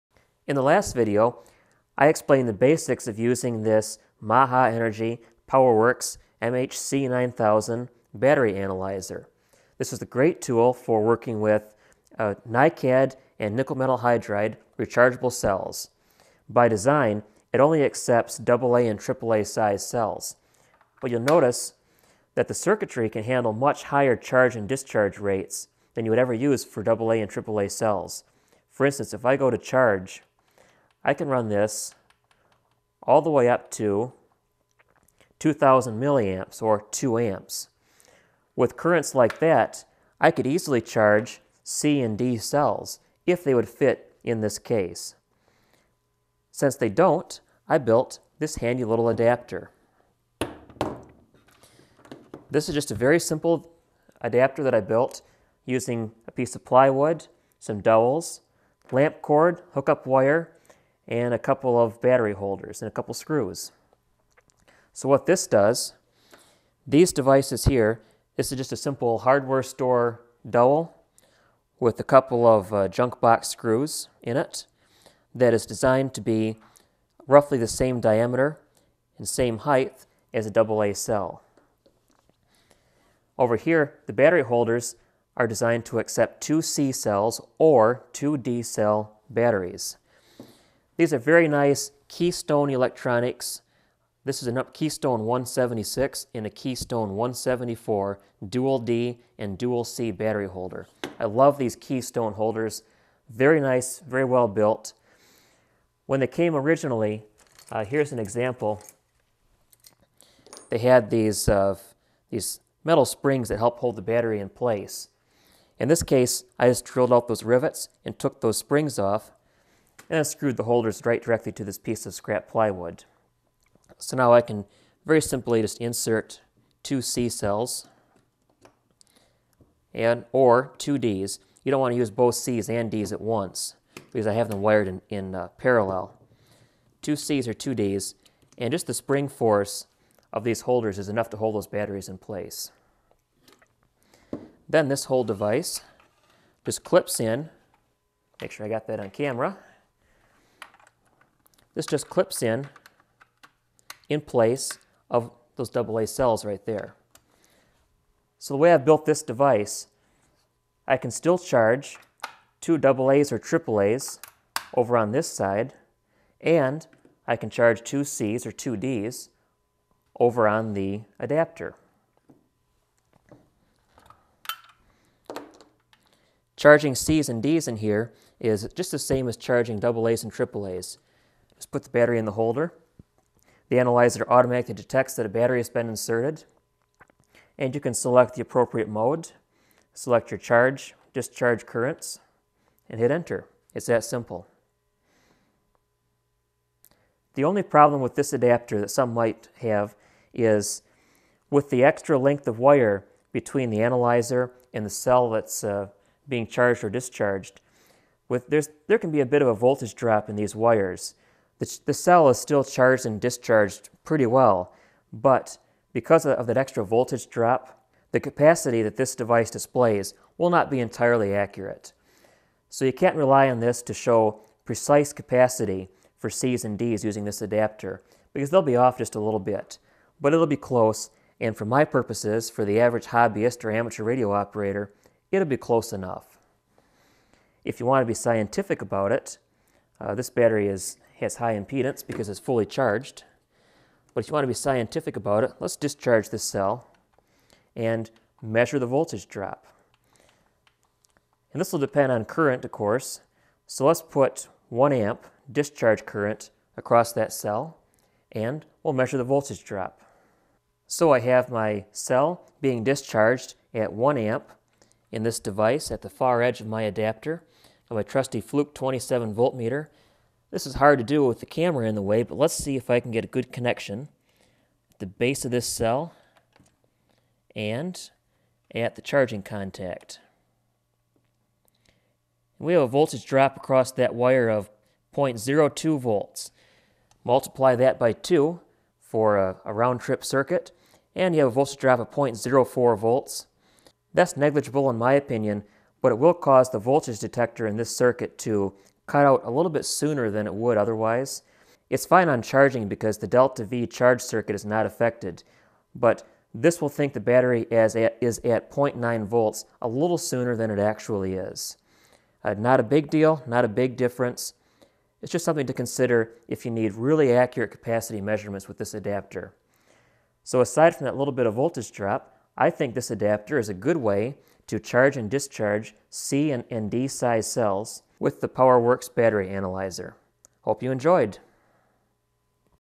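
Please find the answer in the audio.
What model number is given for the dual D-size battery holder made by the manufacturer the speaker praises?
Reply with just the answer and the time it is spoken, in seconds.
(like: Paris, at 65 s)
Keystone 176, at 94 s.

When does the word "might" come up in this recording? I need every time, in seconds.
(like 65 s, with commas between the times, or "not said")
199 s.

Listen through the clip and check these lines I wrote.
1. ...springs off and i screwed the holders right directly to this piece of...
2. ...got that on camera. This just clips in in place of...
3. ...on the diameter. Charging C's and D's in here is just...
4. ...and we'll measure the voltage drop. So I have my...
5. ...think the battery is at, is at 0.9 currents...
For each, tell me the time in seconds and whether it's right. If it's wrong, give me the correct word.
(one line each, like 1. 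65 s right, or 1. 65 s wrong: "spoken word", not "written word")
1. 118 s right
2. 148 s right
3. 170 s wrong: "adapter", not "diameter"
4. 258 s right
5. 306 s wrong: "volts", not "currents".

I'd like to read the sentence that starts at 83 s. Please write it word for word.
Over here, the battery holders are designed to accept two C cells or two D cell batteries.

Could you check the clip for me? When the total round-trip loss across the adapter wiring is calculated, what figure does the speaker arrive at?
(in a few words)
0.04 volts.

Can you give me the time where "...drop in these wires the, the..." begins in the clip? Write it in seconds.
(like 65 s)
209 s.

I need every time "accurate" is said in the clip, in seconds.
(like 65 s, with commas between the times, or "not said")
221 s, 317 s.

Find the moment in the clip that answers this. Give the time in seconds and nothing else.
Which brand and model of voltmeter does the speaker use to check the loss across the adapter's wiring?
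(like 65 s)
268 s.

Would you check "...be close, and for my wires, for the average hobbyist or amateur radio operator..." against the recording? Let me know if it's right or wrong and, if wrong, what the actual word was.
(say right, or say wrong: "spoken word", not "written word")
wrong: "purposes", not "wires".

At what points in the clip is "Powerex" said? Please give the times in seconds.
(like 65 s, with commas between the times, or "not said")
5 s, 328 s.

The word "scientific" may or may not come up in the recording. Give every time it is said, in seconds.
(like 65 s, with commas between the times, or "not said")
238 s, 244 s.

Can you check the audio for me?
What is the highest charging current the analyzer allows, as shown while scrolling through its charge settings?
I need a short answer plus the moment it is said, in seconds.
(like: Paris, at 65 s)
2000 milliamps, at 35 s.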